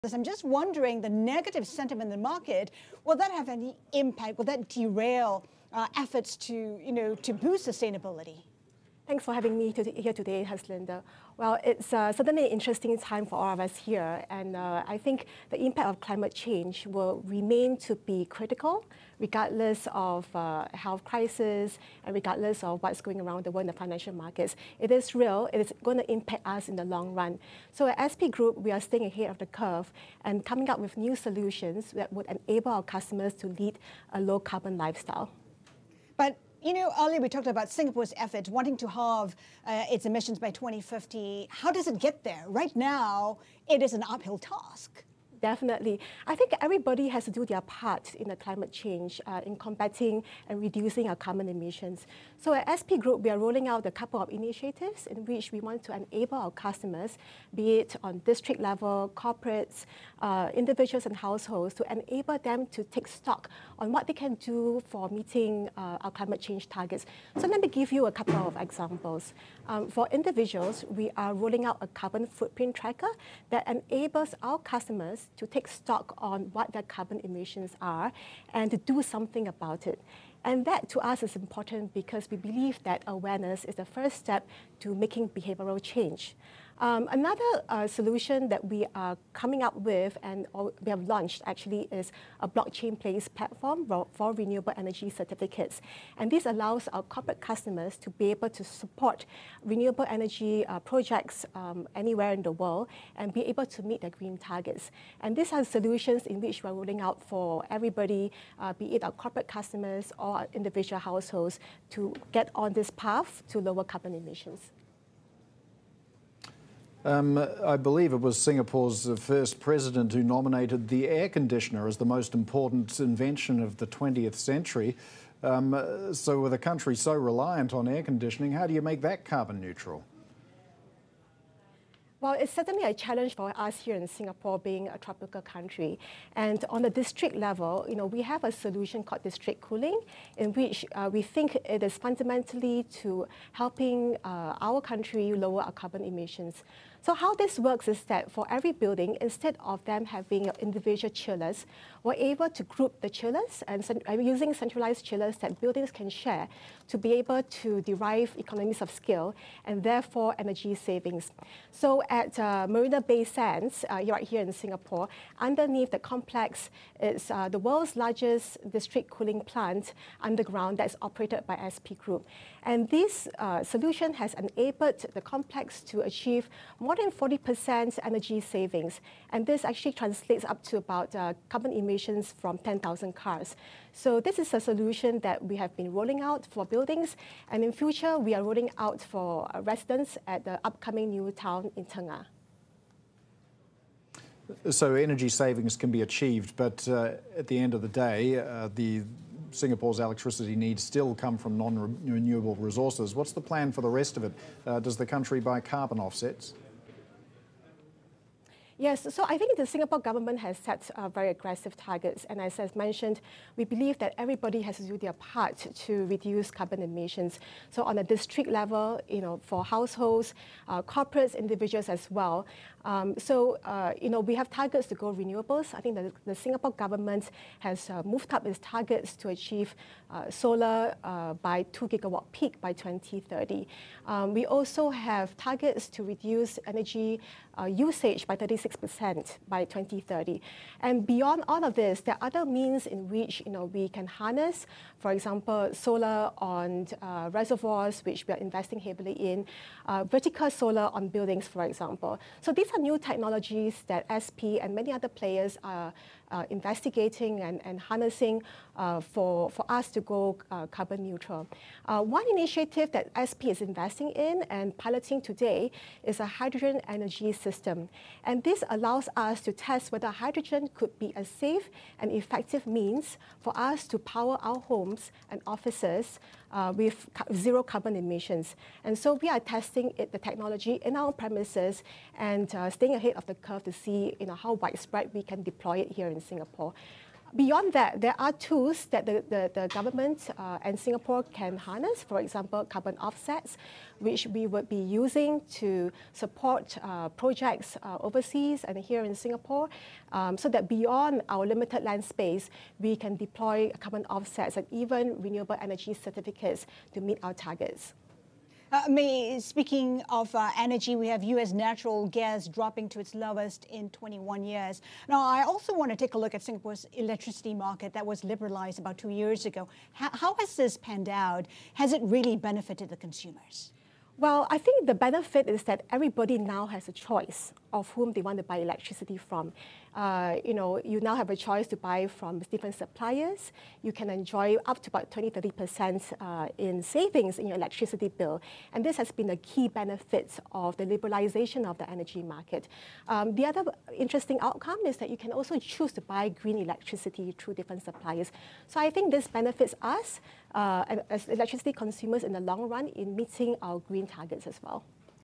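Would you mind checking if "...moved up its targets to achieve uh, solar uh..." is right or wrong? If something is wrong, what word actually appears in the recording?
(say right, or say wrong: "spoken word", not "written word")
right.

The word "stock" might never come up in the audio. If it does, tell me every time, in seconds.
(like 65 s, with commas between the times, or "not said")
63 s, 75 s.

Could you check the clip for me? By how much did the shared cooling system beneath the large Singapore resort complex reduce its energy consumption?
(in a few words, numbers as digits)
More than 40%.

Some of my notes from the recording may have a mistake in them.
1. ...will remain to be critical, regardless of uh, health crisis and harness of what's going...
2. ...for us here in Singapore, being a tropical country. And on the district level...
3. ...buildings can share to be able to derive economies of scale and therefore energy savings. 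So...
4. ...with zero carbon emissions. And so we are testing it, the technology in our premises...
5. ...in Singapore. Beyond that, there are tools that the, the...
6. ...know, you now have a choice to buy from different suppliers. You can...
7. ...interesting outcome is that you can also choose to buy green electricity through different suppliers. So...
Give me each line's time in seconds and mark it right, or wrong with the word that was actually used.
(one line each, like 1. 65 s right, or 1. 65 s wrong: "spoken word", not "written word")
1. 16 s wrong: "regardless", not "harness"
2. 133 s right
3. 155 s right
4. 276 s right
5. 286 s right
6. 330 s right
7. 343 s right.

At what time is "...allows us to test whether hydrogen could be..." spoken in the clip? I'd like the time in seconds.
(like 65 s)
268 s.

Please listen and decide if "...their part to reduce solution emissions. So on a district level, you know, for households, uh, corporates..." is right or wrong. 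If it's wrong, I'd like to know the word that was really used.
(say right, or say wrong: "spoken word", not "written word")
wrong: "carbon", not "solution".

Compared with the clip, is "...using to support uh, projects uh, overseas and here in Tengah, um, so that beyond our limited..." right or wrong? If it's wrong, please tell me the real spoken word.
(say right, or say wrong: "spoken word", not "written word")
wrong: "Singapore", not "Tengah".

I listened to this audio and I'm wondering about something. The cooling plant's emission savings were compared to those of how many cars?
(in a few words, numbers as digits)
10,000.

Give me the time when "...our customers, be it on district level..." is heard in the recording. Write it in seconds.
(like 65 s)
56 s.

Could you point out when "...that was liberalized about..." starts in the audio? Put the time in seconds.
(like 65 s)
317 s.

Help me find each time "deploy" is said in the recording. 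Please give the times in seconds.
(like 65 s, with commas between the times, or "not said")
285 s, 303 s.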